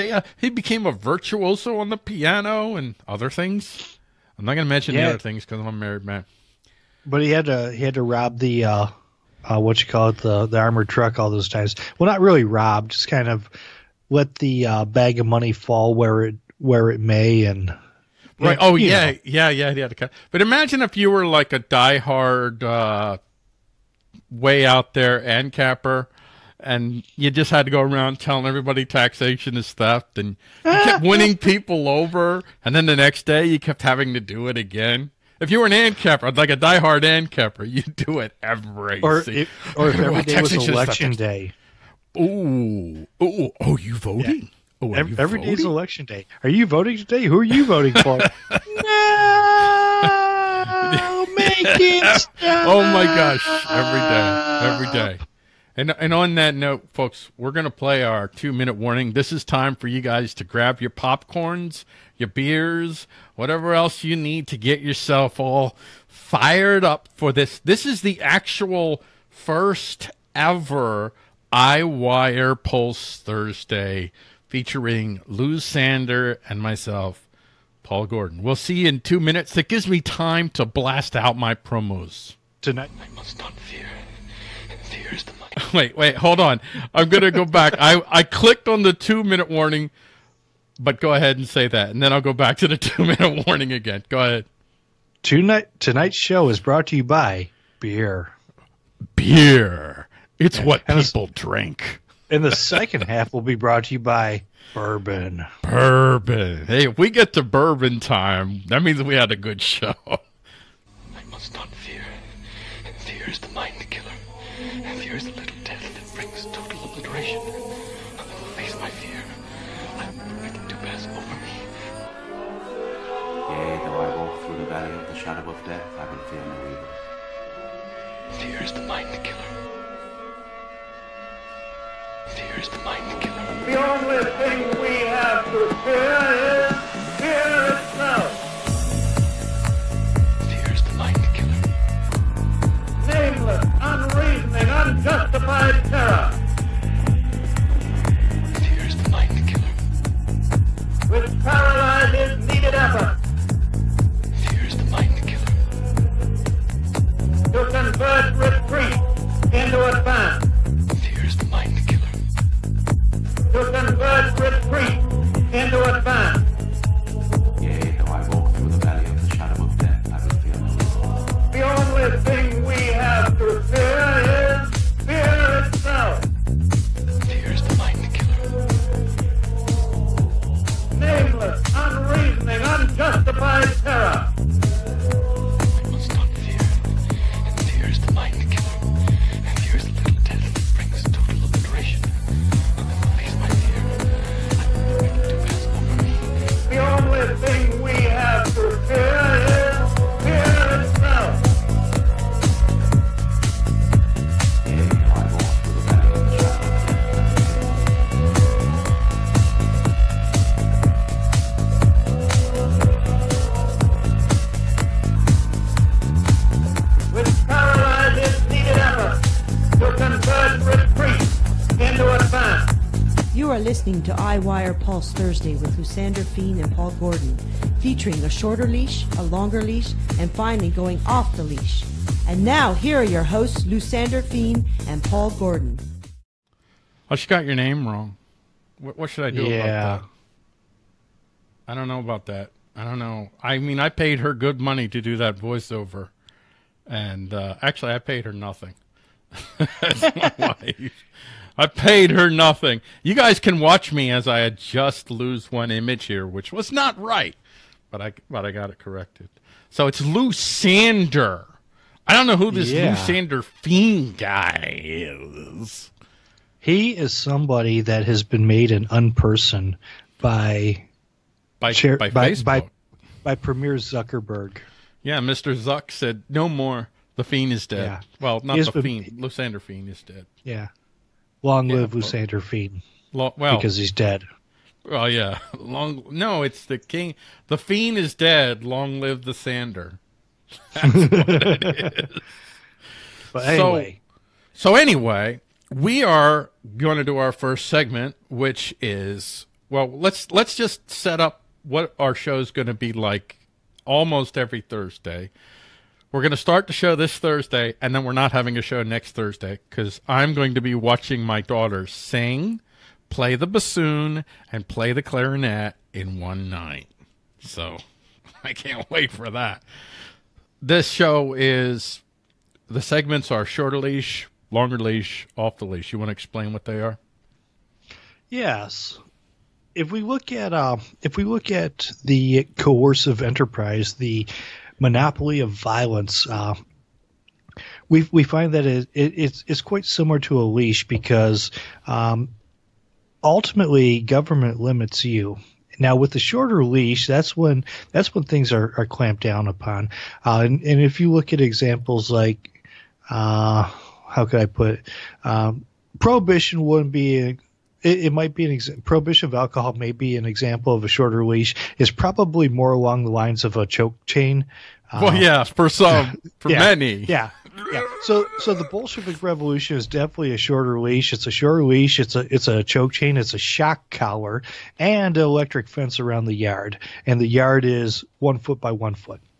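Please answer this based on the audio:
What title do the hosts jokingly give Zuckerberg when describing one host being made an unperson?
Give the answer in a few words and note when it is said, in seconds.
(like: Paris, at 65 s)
Premier, at 273 s.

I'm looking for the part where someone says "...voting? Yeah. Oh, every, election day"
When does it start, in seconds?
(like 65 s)
43 s.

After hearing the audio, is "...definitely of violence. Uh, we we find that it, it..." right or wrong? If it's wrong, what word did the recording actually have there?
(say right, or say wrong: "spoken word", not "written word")
wrong: "monopoly", not "definitely".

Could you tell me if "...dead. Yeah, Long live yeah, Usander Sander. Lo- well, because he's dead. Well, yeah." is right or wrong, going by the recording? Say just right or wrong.
wrong.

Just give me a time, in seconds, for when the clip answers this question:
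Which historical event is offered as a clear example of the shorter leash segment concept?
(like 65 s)
368 s.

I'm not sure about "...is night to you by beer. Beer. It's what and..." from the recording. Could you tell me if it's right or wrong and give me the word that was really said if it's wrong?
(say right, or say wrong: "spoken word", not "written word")
wrong: "brought", not "night".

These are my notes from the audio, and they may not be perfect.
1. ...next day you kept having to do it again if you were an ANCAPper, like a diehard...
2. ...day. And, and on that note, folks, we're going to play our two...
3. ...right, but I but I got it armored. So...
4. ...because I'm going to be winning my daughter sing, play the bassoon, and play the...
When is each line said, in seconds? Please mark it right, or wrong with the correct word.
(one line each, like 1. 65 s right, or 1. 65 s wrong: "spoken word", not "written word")
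1. 32 s right
2. 54 s right
3. 257 s wrong: "corrected", not "armored"
4. 309 s wrong: "watching", not "winning".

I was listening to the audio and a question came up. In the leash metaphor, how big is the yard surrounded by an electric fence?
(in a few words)
One foot by one.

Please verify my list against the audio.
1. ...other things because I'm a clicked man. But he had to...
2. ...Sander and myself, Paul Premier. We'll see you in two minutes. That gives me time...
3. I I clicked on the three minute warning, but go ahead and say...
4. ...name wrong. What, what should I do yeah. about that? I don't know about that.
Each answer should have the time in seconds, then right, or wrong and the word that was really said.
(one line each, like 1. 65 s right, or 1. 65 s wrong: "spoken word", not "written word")
1. 5 s wrong: "married", not "clicked"
2. 75 s wrong: "Gordon", not "Premier"
3. 87 s wrong: "two", not "three"
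4. 237 s right.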